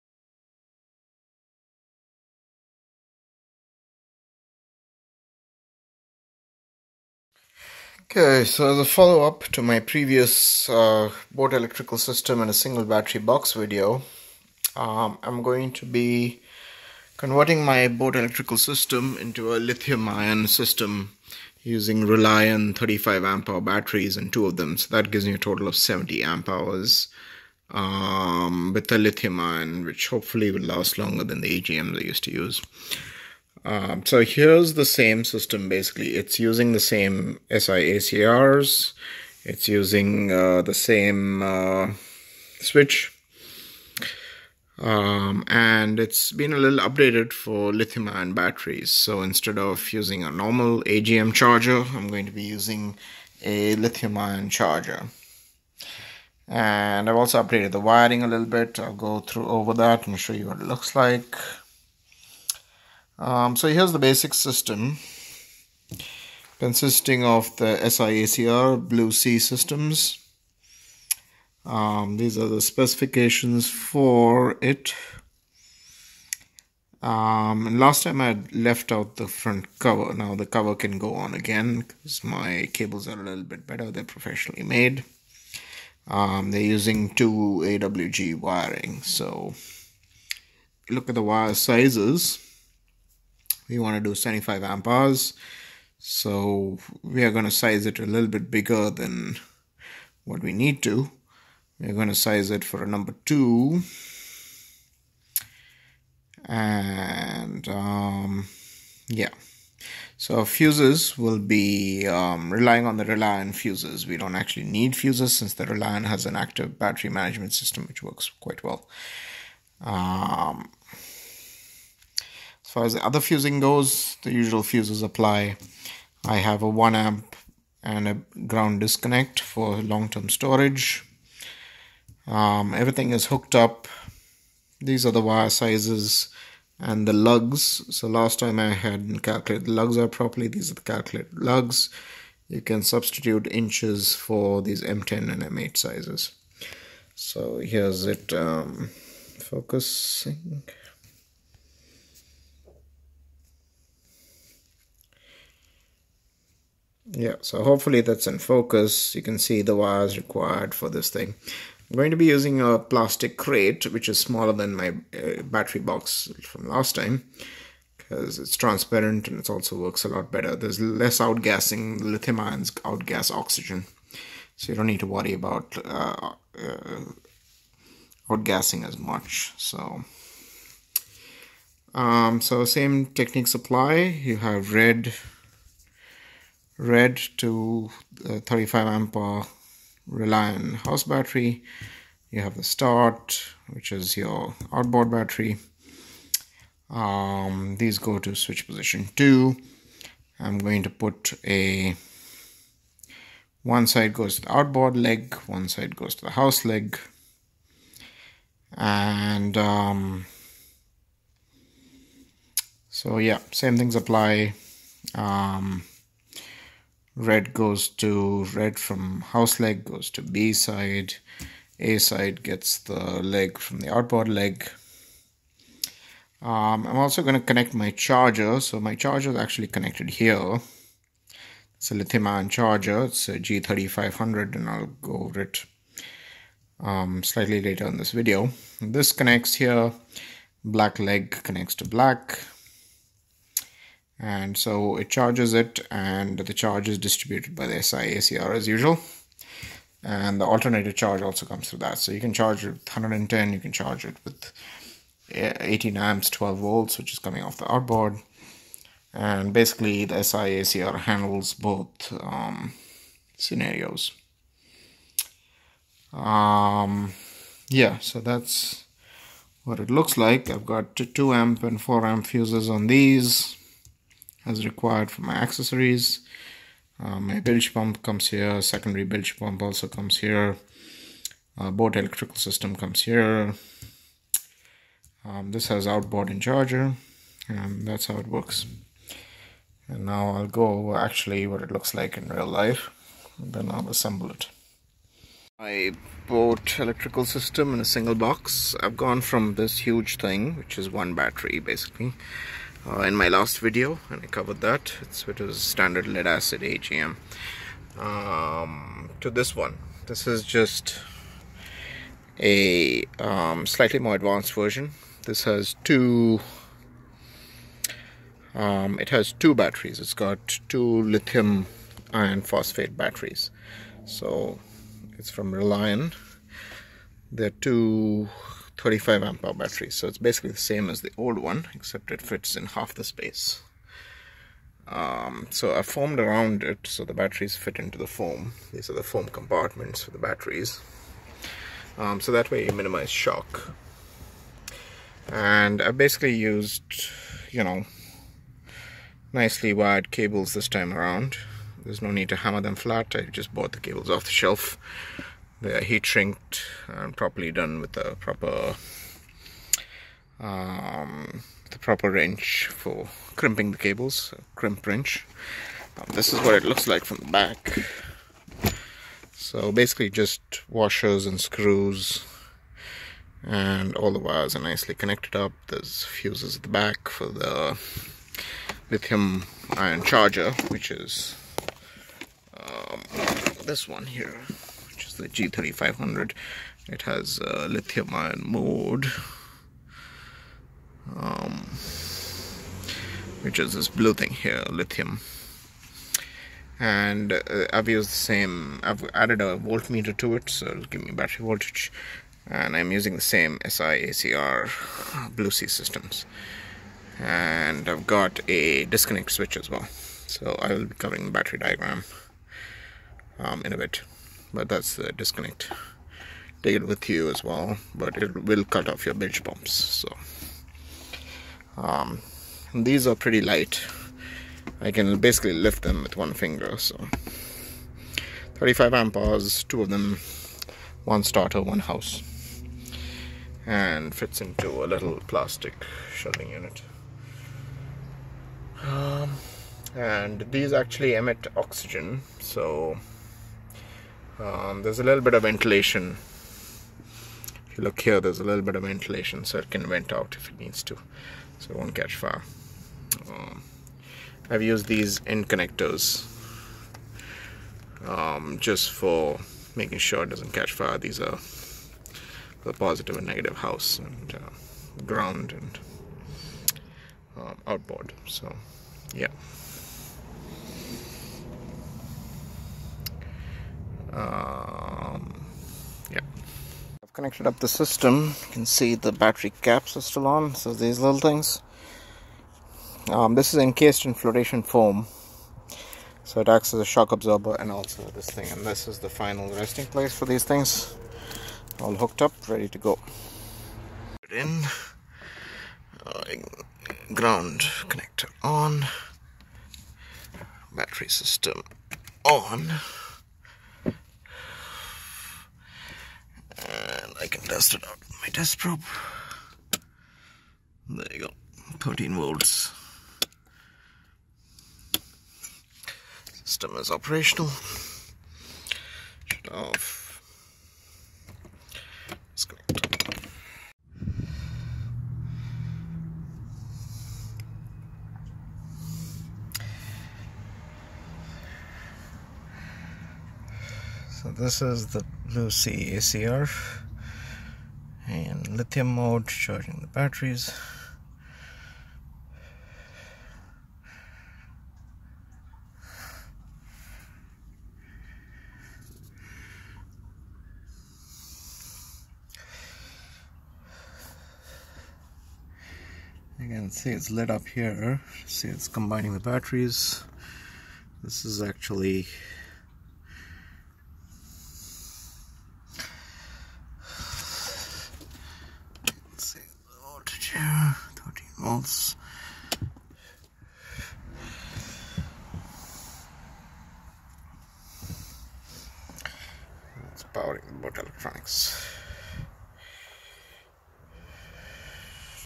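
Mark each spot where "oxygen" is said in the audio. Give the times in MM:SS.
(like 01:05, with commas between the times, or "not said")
02:53, 07:21.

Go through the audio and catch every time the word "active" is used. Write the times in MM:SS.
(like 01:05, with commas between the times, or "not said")
01:56.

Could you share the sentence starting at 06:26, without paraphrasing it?
It has uh, lithium ion mode, um, which is this blue thing here, lithium.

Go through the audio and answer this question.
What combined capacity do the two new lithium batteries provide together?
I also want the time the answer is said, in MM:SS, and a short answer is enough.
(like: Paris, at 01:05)
70 amp hours, at 00:25.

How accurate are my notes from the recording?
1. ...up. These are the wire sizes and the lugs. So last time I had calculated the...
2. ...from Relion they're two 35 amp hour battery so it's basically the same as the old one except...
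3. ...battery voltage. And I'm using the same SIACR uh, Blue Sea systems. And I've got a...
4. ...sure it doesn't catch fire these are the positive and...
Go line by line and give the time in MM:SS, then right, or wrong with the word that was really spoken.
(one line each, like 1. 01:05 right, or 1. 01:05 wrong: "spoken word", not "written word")
1. 02:13 right
2. 05:25 right
3. 06:41 right
4. 07:39 right.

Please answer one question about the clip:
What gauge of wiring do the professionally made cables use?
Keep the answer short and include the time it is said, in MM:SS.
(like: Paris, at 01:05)
2 AWG, at 01:27.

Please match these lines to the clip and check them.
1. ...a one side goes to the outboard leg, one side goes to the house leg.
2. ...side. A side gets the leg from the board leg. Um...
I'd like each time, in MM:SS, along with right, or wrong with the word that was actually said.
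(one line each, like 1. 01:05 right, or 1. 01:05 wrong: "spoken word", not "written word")
1. 03:21 right
2. 03:40 wrong: "outboard", not "board".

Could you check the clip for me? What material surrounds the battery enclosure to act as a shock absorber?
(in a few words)
flotation foam.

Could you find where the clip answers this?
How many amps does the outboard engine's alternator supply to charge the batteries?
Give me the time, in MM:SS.
04:15.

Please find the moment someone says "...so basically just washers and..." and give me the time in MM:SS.
06:09.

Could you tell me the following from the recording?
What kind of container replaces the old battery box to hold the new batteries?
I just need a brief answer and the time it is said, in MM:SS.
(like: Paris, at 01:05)
plastic crate, at 02:42.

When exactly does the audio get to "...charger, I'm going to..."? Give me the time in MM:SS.
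00:51.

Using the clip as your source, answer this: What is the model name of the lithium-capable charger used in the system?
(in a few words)
G3500.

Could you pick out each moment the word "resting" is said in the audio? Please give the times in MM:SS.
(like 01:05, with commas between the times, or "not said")
08:09.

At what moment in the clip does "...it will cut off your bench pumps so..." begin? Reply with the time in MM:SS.
06:58.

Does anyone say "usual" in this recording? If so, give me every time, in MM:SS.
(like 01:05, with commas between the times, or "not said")
02:04, 04:08.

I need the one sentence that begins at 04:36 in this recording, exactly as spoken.
Uh, my bilge pump comes here, secondary bilge pump also comes here, uh, boat electrical system comes here.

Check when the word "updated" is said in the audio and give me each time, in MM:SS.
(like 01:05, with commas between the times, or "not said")
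00:46, 00:57.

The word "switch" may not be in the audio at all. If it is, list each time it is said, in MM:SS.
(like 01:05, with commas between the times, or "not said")
00:42, 03:18, 06:49.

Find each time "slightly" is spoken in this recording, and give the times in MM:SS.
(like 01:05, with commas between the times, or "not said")
03:57, 05:13.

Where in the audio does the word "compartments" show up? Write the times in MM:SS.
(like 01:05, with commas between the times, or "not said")
05:39.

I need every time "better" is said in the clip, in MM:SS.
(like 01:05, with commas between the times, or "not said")
01:23, 02:50.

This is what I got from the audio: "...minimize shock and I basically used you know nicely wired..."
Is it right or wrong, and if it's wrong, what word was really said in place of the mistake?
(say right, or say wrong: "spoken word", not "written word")
right.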